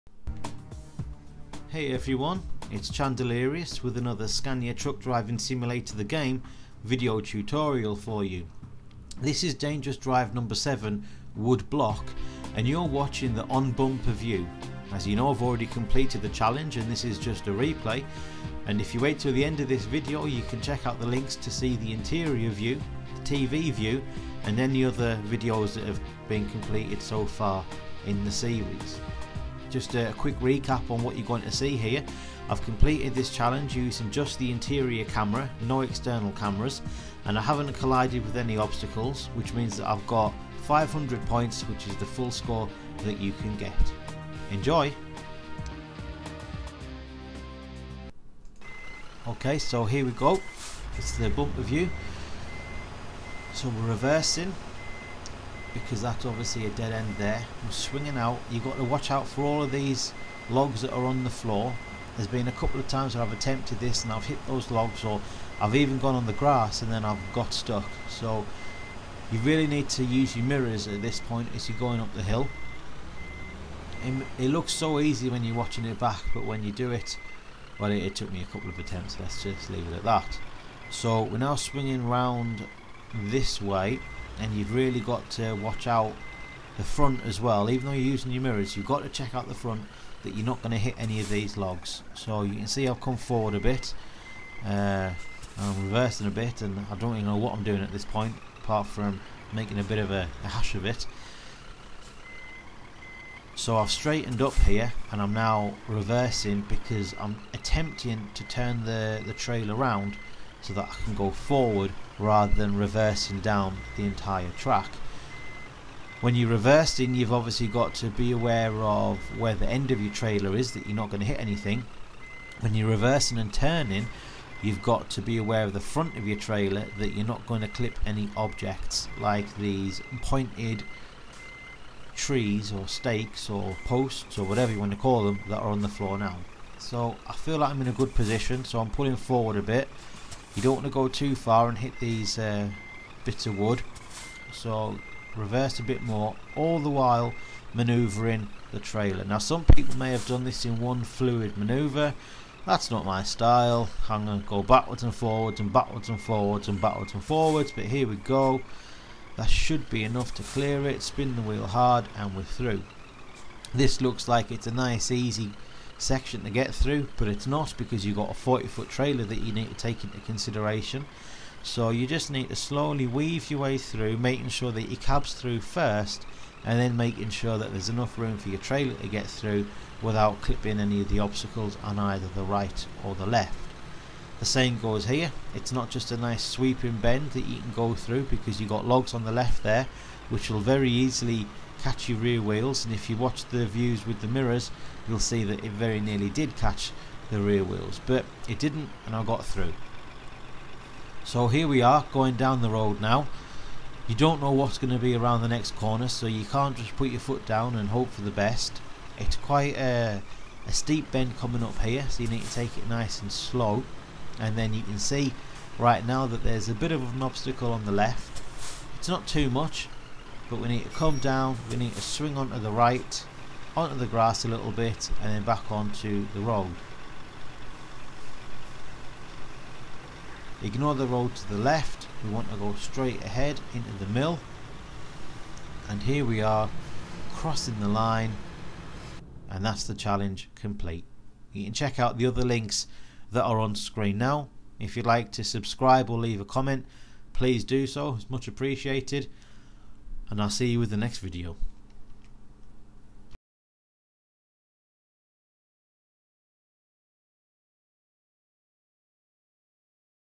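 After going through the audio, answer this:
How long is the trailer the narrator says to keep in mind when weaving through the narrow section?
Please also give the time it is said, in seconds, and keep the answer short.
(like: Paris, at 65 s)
40 foot, at 168 s.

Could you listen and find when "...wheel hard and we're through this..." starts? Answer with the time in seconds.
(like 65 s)
161 s.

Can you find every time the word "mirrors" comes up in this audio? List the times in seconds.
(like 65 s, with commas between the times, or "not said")
70 s, 88 s, 194 s.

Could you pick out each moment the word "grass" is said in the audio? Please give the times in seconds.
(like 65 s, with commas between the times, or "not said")
66 s, 224 s.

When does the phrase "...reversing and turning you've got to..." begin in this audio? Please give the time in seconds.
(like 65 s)
122 s.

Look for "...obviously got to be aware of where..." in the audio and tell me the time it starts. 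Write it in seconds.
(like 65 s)
117 s.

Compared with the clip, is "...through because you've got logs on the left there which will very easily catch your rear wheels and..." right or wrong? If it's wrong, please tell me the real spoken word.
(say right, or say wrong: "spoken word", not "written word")
right.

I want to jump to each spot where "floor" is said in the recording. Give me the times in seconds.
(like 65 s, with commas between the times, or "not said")
61 s, 135 s.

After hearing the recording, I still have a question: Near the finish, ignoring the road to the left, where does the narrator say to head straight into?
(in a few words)
The mill.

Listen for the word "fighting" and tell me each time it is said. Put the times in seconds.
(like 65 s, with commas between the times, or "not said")
not said.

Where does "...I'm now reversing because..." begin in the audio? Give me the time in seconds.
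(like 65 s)
105 s.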